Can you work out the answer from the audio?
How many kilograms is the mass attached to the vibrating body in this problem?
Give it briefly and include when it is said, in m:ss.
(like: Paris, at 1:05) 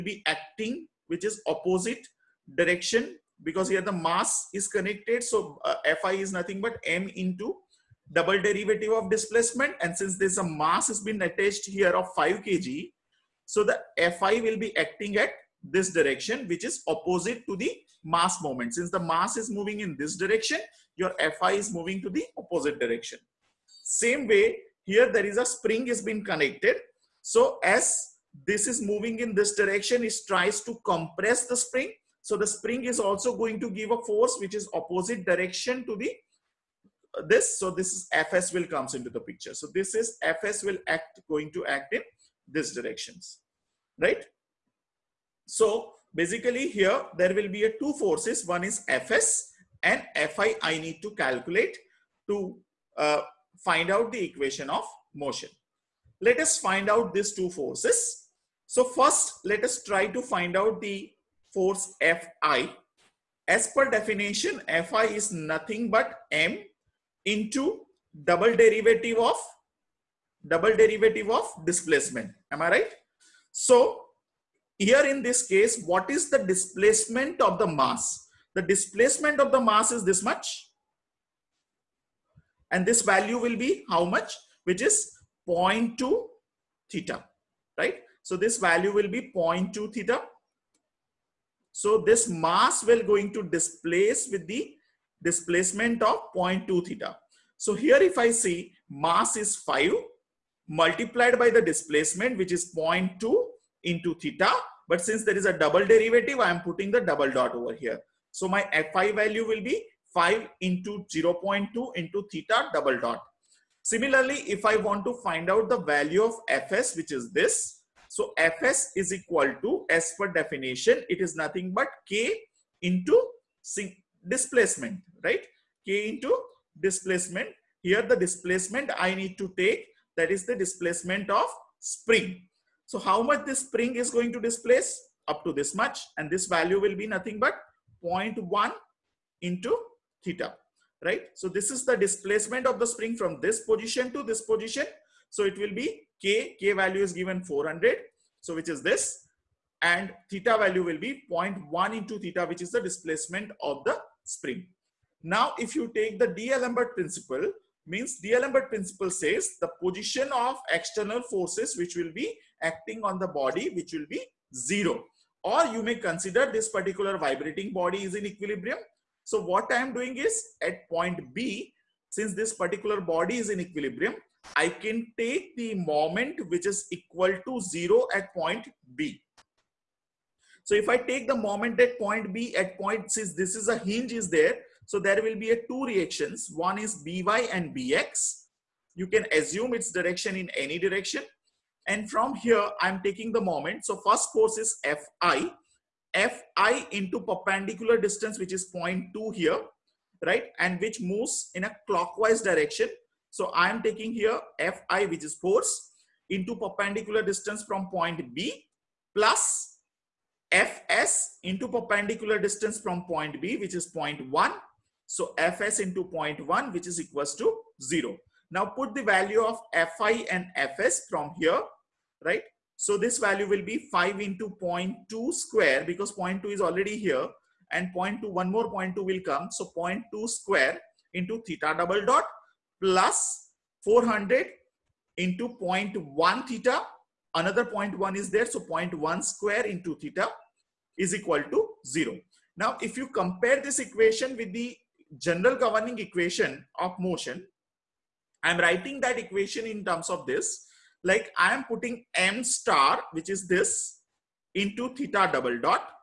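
5, at 0:12.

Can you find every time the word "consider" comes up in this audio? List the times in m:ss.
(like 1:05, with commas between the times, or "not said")
2:45.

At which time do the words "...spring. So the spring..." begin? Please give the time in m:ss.
0:31.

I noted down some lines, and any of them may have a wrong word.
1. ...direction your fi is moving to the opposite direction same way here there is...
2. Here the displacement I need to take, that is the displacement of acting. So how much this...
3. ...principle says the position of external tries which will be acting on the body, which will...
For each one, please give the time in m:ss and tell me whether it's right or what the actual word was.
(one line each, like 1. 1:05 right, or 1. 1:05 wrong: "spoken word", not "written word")
1. 0:20 right
2. 2:07 wrong: "spring", not "acting"
3. 2:38 wrong: "forces", not "tries".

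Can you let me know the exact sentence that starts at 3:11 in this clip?
And from here, I'm taking the moment.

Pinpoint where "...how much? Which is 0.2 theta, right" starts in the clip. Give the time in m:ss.
1:23.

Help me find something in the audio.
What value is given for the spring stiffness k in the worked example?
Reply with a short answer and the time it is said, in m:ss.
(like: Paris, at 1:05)
400, at 2:26.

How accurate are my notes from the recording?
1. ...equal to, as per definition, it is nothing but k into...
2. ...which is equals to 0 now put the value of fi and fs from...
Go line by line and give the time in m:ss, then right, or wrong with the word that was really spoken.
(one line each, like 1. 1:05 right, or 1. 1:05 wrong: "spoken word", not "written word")
1. 1:59 right
2. 3:36 right.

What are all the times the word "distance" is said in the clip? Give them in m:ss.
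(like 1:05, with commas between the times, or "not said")
3:17, 3:27, 3:32.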